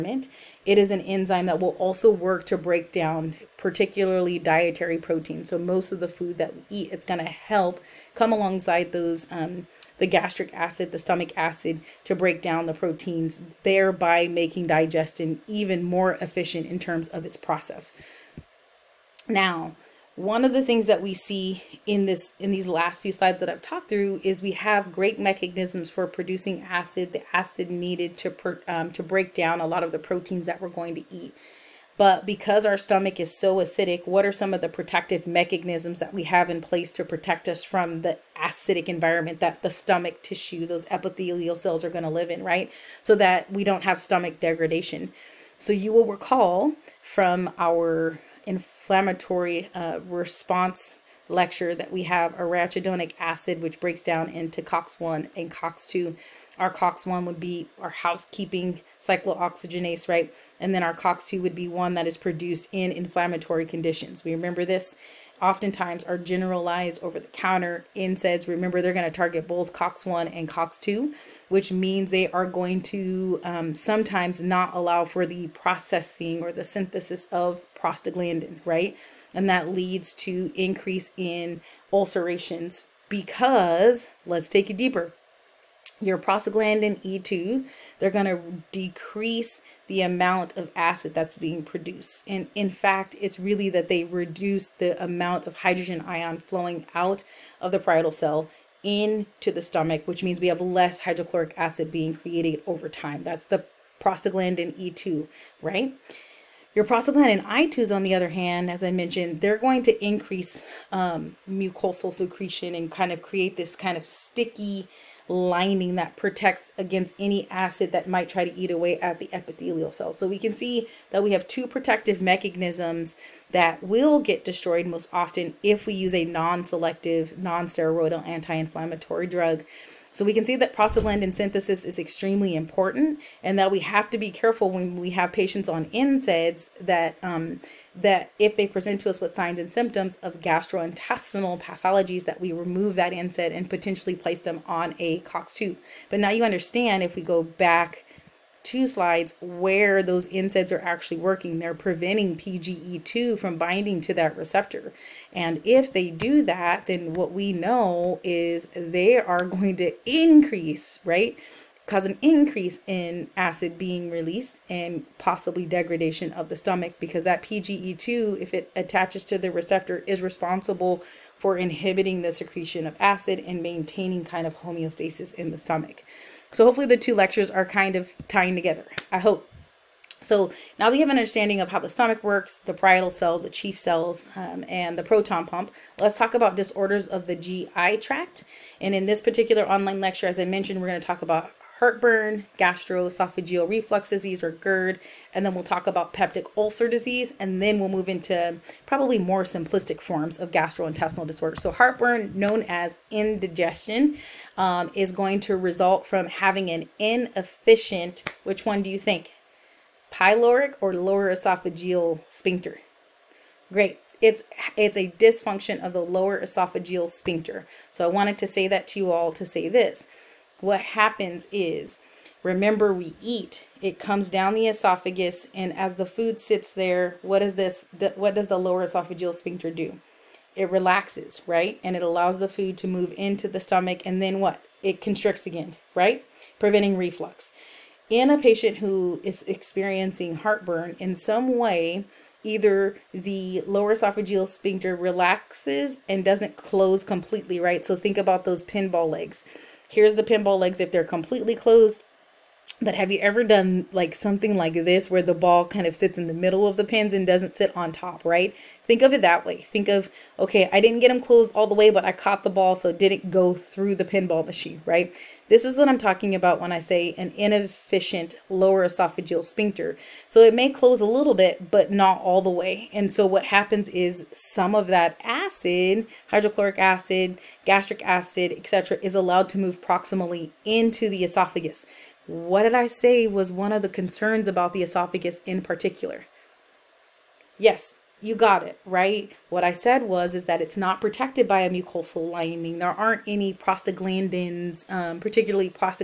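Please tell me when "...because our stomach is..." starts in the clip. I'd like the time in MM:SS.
00:32.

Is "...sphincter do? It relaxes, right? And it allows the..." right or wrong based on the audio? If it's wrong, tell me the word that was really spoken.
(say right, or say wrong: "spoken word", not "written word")
right.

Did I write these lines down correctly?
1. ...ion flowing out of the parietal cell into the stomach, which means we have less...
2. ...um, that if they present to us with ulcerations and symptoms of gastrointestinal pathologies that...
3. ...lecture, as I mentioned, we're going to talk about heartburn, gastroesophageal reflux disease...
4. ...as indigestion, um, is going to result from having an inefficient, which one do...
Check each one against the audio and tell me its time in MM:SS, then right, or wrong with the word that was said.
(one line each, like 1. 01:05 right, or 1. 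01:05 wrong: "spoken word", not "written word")
1. 01:36 right
2. 02:17 wrong: "signs", not "ulcerations"
3. 03:10 right
4. 03:22 right.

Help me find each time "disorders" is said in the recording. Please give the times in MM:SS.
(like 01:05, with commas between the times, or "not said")
03:06, 03:21.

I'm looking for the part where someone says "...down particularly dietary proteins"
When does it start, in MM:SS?
00:02.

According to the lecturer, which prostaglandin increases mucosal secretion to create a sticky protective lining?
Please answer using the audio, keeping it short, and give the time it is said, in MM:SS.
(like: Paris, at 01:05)
Prostaglandin I2, at 01:46.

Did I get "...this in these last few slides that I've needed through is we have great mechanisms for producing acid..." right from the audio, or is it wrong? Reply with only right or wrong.
wrong.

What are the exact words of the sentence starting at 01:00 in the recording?
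And then our COX-2 would be one that is produced in inflammatory conditions.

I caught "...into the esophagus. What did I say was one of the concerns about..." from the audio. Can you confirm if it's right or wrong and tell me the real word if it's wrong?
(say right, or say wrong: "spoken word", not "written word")
right.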